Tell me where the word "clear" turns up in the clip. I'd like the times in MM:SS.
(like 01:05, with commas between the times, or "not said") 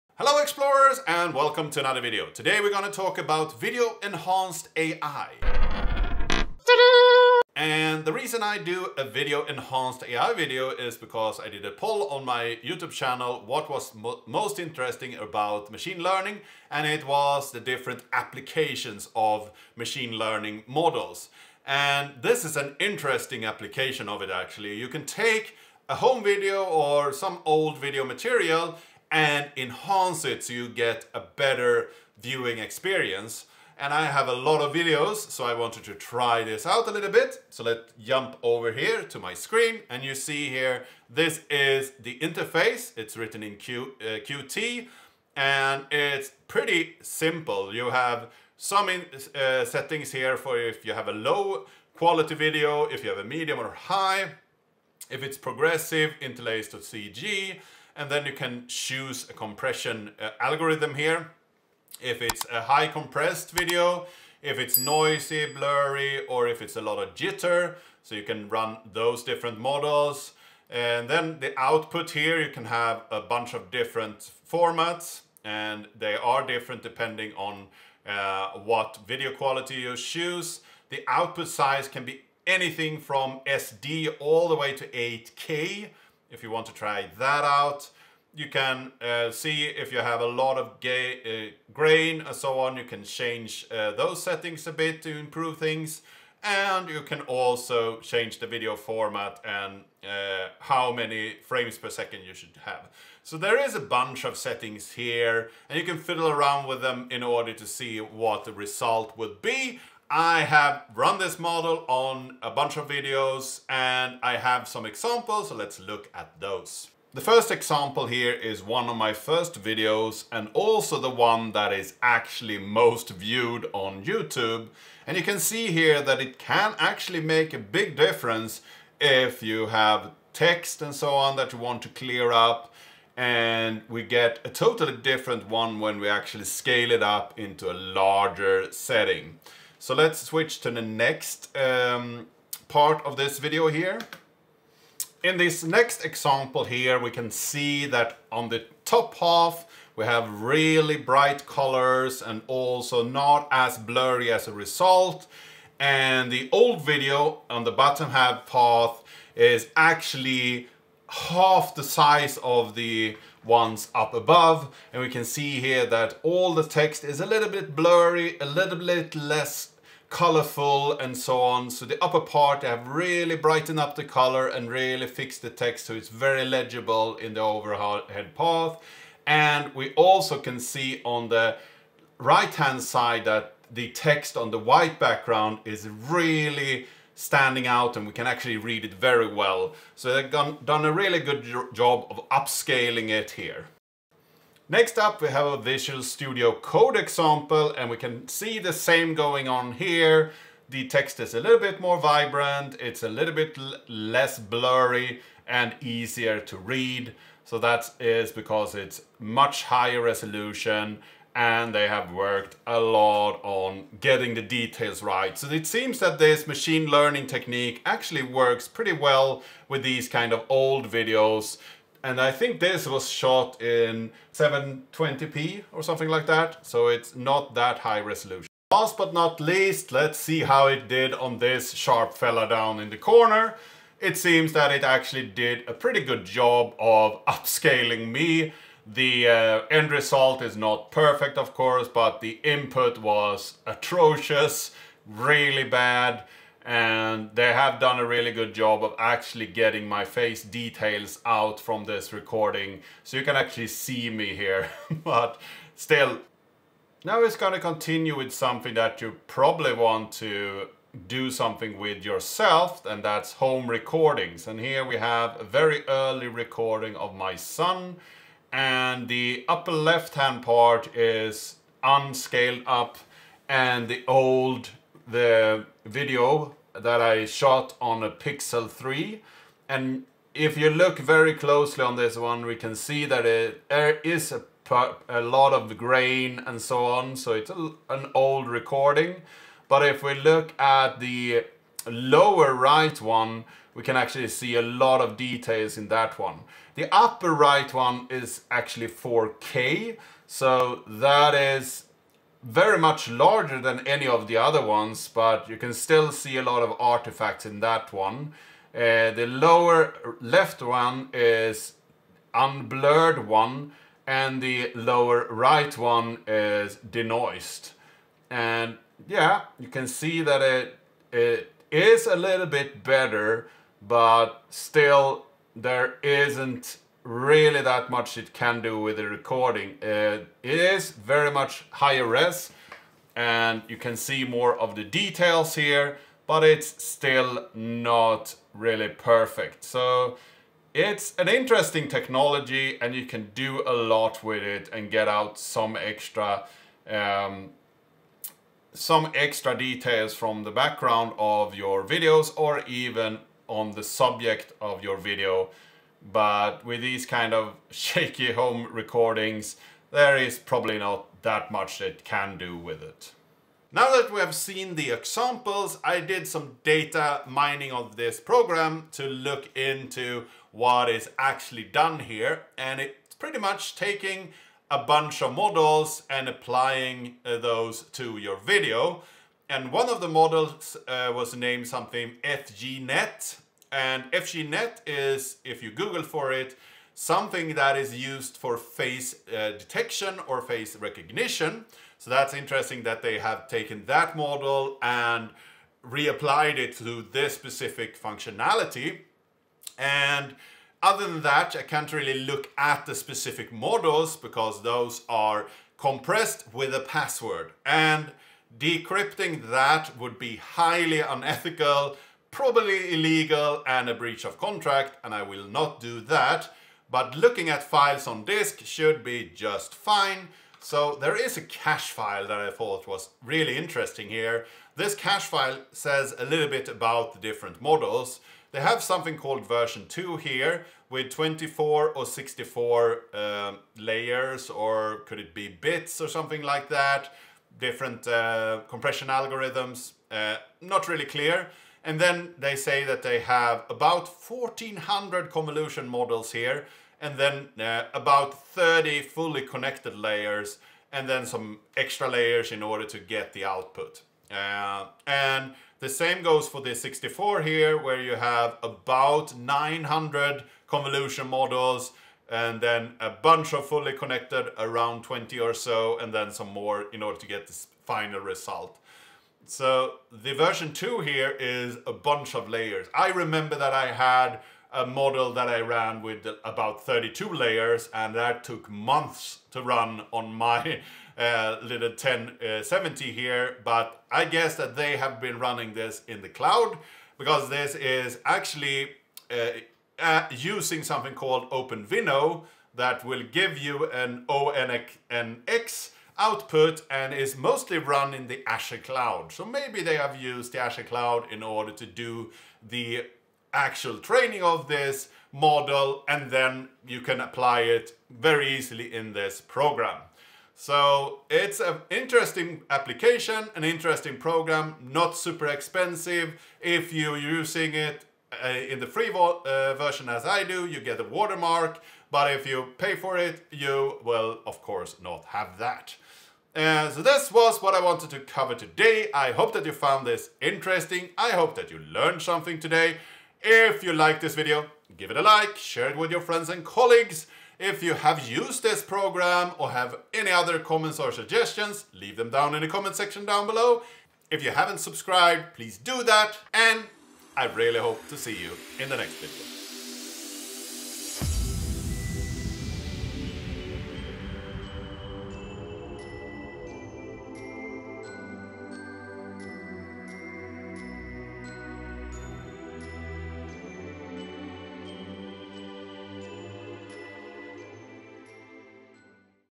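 02:11, 07:21.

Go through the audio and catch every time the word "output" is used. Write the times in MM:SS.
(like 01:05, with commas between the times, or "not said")
01:11, 01:21, 07:33, 08:16.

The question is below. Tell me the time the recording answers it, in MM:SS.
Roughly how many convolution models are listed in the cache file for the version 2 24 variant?
07:24.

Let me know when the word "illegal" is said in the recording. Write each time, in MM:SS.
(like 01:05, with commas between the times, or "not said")
06:52.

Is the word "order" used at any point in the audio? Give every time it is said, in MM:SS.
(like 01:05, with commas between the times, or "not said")
01:47, 07:32, 07:47, 08:21.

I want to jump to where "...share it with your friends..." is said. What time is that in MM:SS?
08:55.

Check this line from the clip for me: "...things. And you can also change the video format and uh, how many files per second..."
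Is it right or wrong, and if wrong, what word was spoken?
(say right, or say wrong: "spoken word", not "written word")
wrong: "frames", not "files".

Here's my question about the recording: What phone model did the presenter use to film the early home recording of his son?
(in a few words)
Pixel 3.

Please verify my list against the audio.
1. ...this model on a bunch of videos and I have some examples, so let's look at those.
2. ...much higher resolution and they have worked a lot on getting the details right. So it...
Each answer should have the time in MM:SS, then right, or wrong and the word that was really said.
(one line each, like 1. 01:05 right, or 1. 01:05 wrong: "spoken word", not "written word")
1. 01:51 right
2. 03:29 right.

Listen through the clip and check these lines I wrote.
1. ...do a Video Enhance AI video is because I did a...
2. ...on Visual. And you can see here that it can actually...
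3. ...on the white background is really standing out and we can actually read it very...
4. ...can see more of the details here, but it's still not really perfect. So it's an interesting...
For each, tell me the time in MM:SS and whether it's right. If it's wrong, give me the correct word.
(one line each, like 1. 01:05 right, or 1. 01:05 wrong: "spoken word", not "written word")
1. 00:08 right
2. 02:03 wrong: "YouTube", not "Visual"
3. 03:04 right
4. 05:33 right.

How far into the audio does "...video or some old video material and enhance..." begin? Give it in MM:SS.
00:26.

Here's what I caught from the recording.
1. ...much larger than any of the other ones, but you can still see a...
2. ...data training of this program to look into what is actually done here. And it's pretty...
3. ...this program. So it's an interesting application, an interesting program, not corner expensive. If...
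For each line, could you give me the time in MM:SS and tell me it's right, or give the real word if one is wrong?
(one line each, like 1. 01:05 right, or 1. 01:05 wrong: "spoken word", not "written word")
1. 05:02 right
2. 06:06 wrong: "mining", not "training"
3. 08:29 wrong: "super", not "corner".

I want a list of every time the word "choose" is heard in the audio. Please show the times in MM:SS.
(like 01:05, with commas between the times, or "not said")
00:58, 01:19.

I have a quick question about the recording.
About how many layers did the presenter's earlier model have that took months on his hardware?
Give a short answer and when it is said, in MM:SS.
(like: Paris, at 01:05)
32, at 07:56.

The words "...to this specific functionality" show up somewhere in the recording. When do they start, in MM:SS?
06:36.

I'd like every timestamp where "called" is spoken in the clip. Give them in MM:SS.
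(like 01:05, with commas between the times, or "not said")
07:09, 08:11.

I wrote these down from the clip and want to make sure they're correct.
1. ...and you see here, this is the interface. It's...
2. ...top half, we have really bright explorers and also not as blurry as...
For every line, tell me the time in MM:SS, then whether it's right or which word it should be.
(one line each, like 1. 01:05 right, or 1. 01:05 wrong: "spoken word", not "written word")
1. 00:39 right
2. 02:28 wrong: "colors", not "explorers".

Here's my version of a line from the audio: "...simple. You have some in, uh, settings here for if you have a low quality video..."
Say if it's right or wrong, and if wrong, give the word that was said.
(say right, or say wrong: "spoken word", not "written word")
right.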